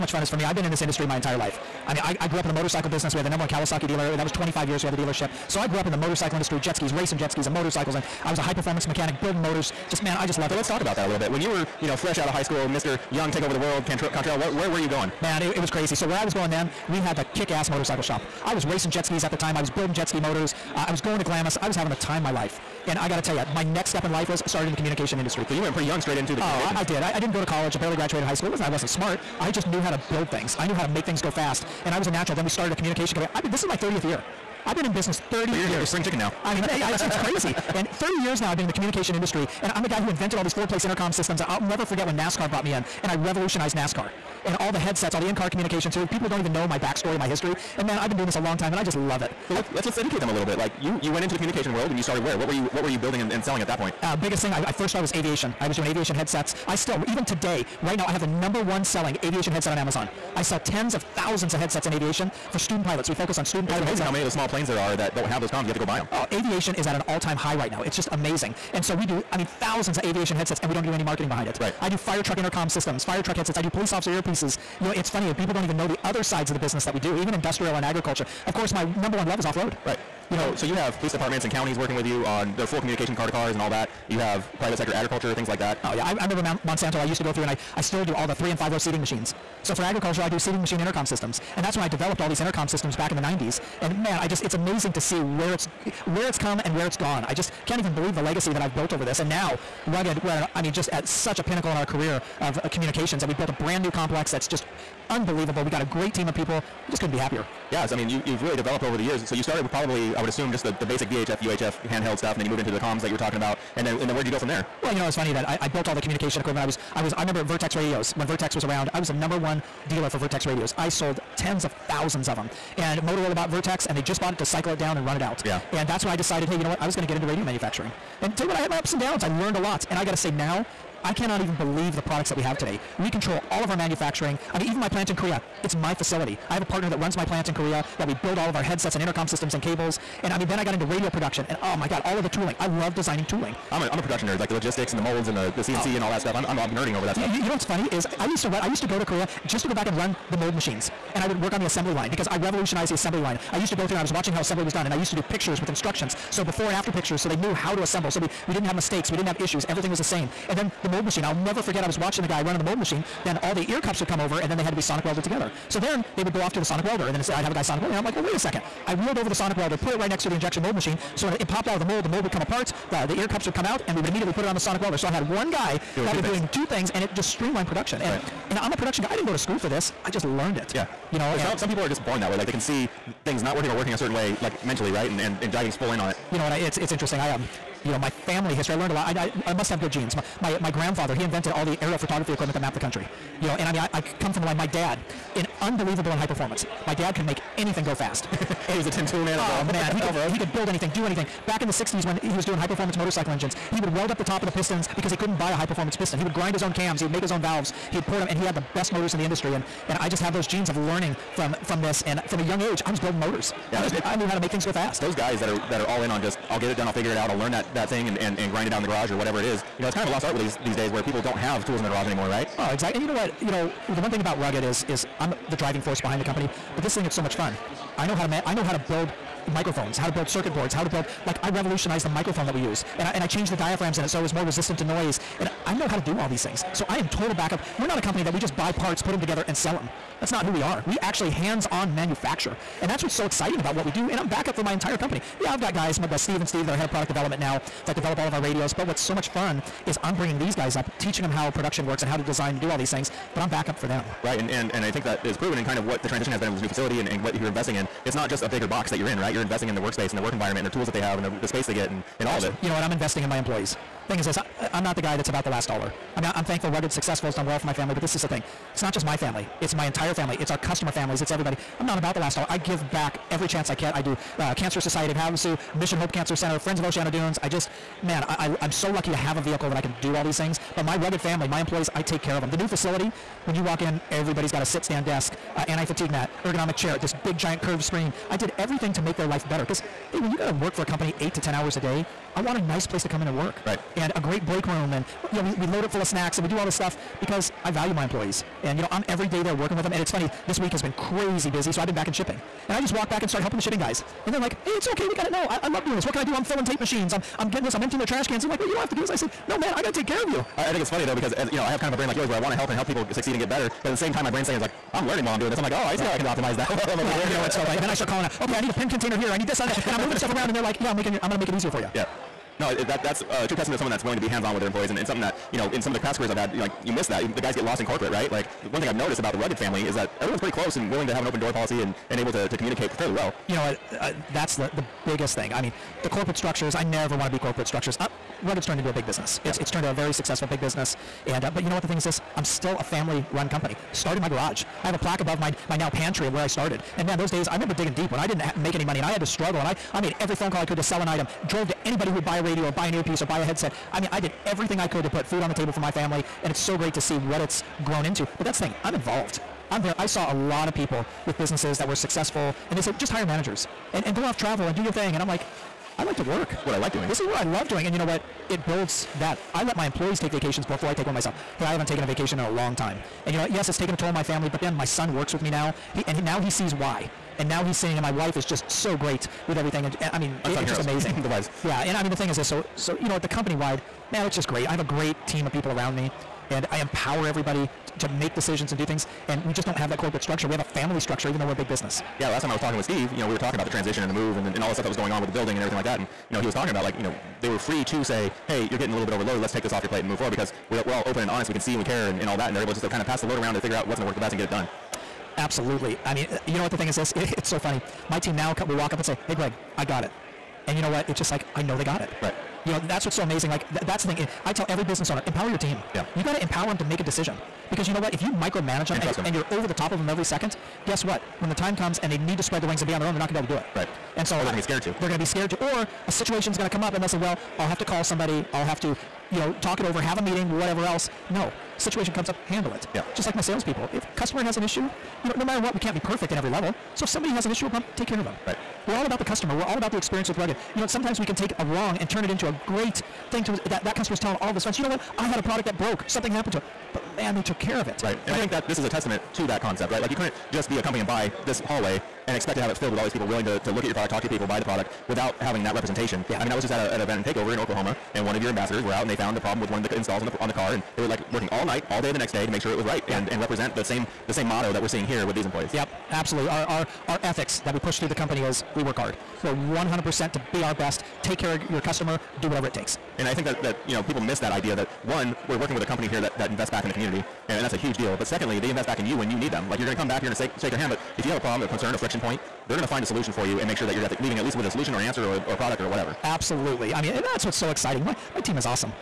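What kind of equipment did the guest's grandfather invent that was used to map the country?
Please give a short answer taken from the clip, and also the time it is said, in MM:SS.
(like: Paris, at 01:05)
aerial photography equipment, at 03:11.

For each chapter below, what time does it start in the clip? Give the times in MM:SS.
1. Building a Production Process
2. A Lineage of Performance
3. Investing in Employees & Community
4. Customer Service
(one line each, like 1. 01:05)
1. 01:47
2. 02:57
3. 04:05
4. 07:52.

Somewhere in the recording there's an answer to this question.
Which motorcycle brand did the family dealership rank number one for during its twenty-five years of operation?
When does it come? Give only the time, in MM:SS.
00:03.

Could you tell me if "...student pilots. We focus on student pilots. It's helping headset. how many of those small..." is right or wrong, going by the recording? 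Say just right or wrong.
wrong.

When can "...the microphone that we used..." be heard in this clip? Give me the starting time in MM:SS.
03:52.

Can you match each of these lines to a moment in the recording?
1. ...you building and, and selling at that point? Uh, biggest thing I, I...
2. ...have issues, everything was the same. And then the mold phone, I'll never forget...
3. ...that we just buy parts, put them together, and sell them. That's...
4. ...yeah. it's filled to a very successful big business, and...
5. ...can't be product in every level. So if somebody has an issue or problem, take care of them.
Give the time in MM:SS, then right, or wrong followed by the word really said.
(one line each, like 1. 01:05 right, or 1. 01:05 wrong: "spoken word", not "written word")
1. 00:52 right
2. 02:39 wrong: "machine", not "phone"
3. 03:58 right
4. 05:39 wrong: "turned", not "filled"
5. 07:15 wrong: "perfect", not "product".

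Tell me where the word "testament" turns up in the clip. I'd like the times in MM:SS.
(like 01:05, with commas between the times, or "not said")
05:23, 07:28.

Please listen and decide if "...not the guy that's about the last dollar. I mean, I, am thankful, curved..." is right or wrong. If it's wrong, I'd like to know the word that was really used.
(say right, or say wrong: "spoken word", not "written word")
wrong: "rugged", not "curved".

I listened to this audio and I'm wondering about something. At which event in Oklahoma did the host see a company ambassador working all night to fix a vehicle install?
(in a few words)
Takeover.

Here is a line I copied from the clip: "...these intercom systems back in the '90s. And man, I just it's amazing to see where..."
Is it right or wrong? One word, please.
right.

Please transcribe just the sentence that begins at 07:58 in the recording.
But secondly, they invest back in you when you need them.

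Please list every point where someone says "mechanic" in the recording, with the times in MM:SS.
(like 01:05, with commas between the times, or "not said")
00:08.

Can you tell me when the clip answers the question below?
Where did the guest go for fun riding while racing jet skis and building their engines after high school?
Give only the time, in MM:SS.
00:21.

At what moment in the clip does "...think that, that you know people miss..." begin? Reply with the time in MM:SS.
07:53.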